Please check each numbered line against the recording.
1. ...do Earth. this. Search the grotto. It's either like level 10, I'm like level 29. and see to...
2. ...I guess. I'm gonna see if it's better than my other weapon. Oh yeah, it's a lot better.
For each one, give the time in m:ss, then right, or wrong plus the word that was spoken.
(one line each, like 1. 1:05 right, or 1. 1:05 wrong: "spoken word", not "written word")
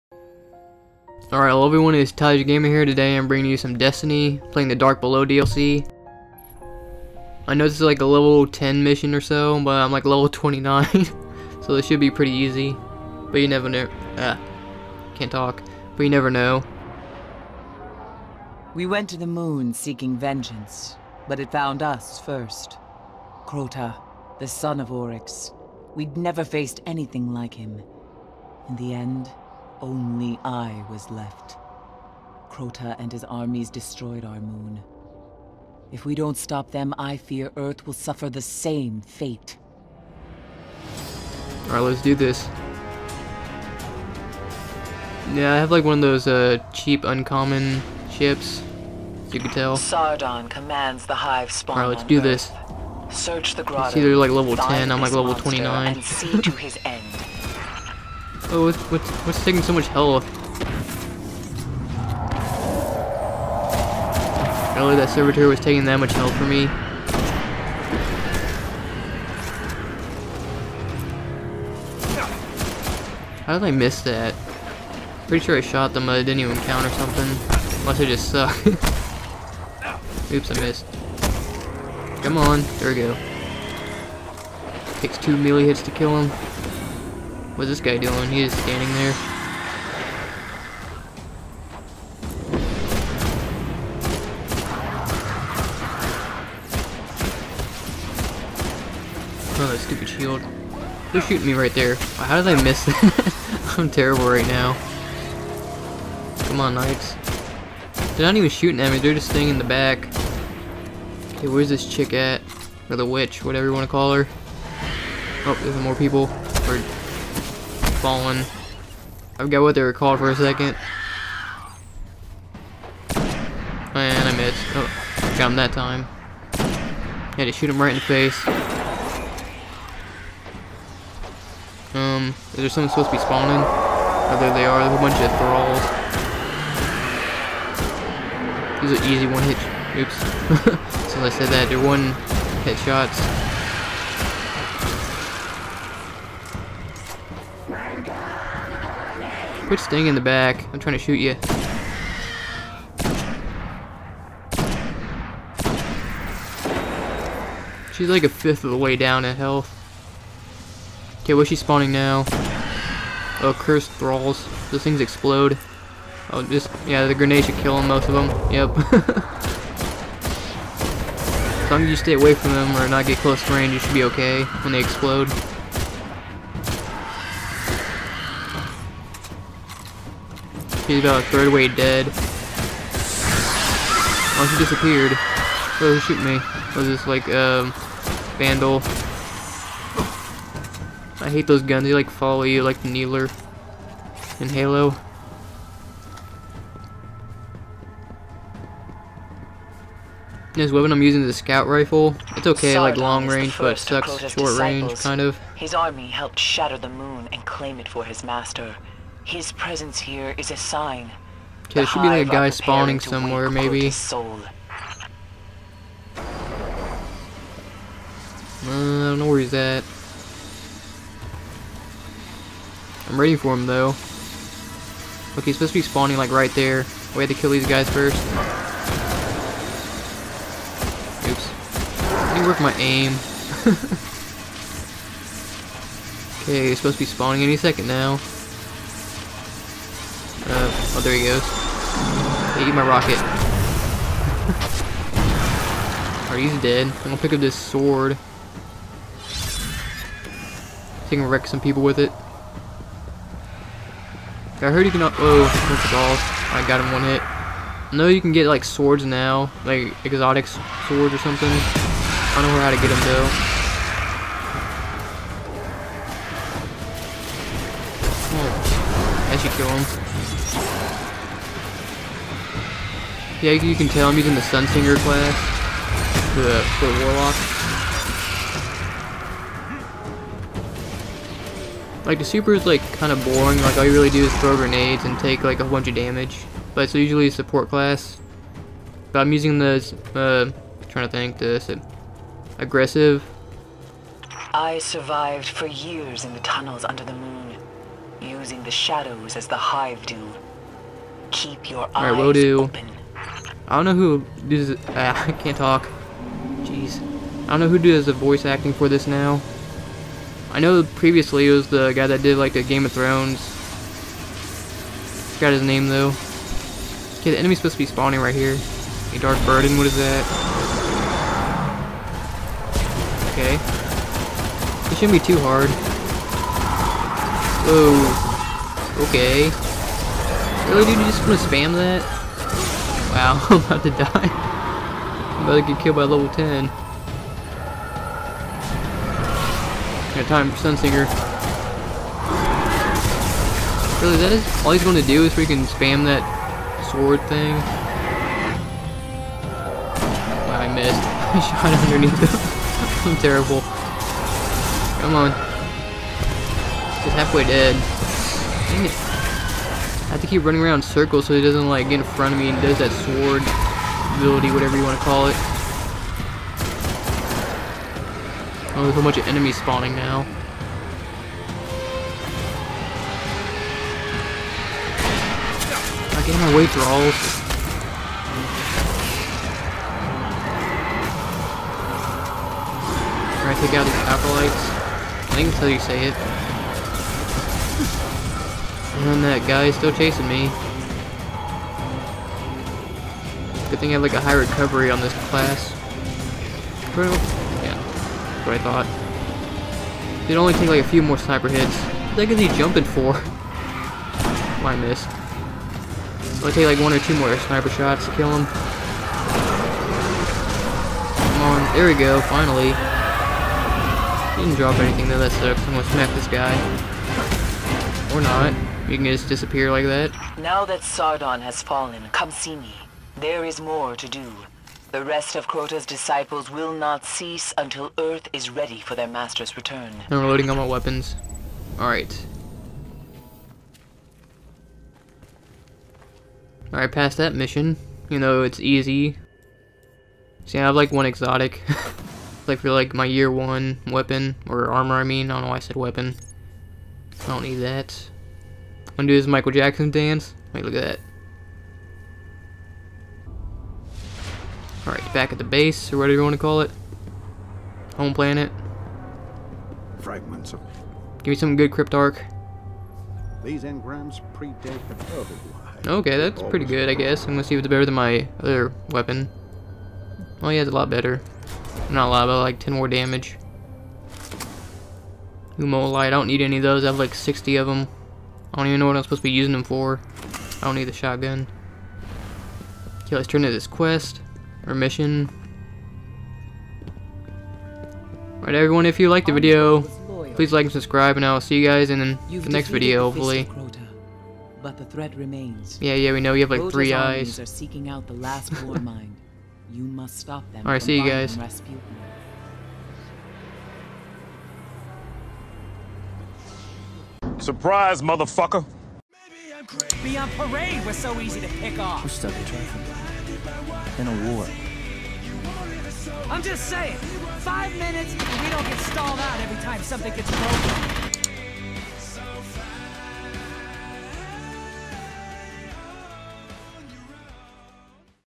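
1. 0:52 right
2. 7:46 right.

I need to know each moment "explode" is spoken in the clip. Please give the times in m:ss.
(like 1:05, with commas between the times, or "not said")
2:44, 2:54.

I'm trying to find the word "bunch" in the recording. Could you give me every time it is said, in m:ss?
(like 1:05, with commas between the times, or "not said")
2:15, 4:45, 6:09.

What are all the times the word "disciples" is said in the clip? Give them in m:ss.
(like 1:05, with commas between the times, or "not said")
3:24, 7:05.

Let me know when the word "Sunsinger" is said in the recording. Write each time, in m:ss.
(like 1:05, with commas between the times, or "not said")
4:34, 5:40.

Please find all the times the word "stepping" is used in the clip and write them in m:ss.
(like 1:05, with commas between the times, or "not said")
not said.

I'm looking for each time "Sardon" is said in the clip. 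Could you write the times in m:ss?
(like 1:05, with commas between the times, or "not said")
0:49, 3:22, 7:00.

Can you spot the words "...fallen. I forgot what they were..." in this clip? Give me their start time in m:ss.
1:58.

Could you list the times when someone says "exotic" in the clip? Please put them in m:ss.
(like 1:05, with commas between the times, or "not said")
4:20, 7:21.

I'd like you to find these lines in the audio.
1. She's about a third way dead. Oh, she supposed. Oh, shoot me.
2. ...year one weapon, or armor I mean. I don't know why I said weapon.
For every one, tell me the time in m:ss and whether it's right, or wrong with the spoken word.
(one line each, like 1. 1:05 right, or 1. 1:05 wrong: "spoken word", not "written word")
1. 3:00 wrong: "disappeared", not "supposed"
2. 7:23 right.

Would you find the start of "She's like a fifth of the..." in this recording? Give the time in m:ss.
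2:37.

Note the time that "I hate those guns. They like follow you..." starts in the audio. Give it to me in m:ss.
3:11.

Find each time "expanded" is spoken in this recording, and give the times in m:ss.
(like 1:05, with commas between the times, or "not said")
not said.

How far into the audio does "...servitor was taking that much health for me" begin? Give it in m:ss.
1:05.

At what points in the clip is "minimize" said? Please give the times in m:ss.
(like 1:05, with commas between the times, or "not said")
not said.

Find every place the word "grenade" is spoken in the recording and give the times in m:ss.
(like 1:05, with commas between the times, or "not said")
2:47, 4:44.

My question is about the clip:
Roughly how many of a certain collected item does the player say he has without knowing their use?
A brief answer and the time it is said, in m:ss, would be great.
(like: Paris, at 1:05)
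60, at 7:57.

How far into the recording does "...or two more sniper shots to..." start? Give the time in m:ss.
6:46.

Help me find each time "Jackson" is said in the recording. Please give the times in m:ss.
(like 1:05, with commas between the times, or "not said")
7:29.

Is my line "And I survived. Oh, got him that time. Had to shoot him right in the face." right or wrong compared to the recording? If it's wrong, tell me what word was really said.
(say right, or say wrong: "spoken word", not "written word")
wrong: "missed", not "survived".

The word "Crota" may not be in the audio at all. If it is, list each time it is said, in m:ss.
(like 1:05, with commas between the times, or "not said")
0:23, 0:32, 7:05.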